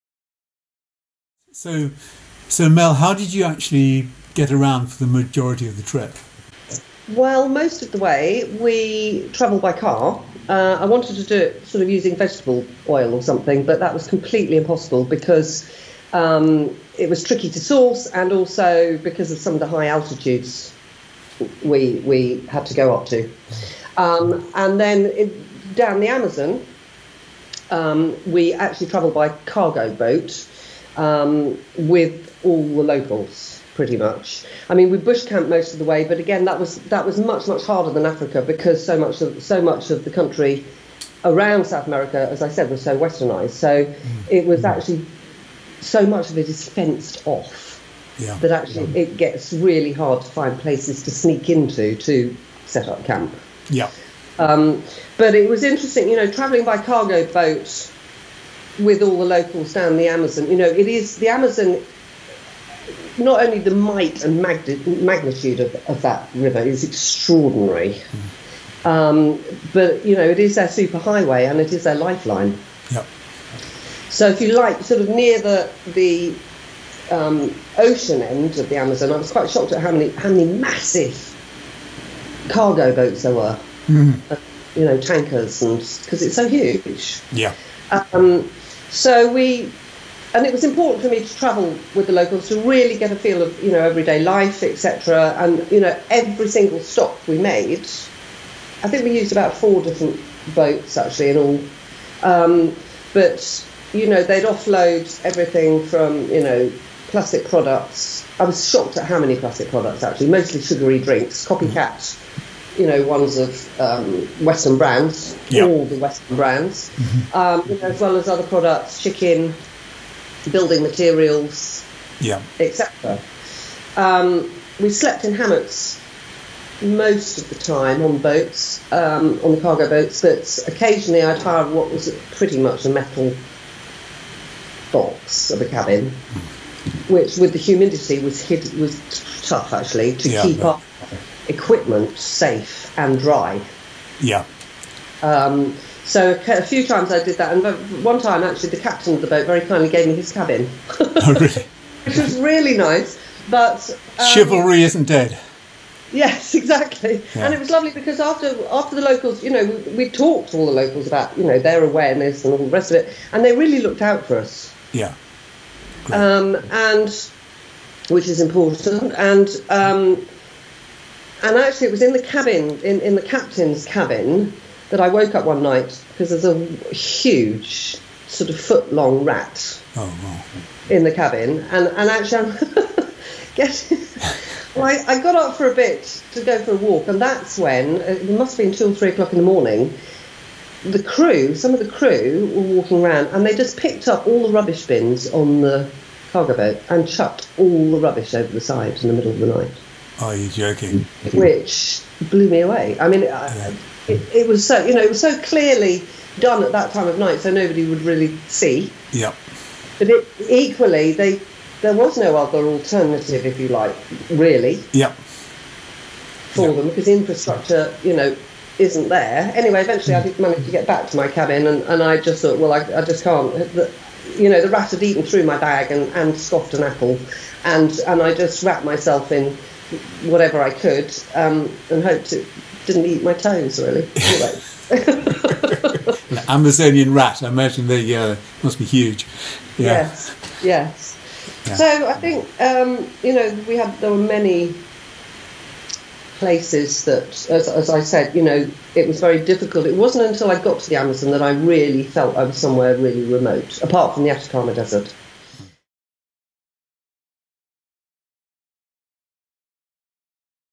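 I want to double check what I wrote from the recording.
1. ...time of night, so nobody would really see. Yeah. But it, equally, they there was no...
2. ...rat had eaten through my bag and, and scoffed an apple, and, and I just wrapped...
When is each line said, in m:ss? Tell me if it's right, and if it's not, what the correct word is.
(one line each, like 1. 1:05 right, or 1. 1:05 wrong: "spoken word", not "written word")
1. 3:26 right
2. 3:44 right.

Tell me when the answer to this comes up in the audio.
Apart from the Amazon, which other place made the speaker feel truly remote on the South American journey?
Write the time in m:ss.
4:14.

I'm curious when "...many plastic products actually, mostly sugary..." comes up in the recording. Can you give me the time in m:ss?
1:49.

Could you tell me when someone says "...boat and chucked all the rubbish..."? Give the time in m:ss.
3:16.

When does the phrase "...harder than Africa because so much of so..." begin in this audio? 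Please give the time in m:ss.
0:37.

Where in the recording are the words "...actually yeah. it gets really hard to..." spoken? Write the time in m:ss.
0:48.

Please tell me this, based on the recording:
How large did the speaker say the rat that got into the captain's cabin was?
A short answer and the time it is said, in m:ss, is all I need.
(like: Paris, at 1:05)
foot long, at 2:58.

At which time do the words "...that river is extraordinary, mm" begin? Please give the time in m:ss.
1:06.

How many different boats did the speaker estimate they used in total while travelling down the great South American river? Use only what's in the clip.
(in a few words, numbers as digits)
4.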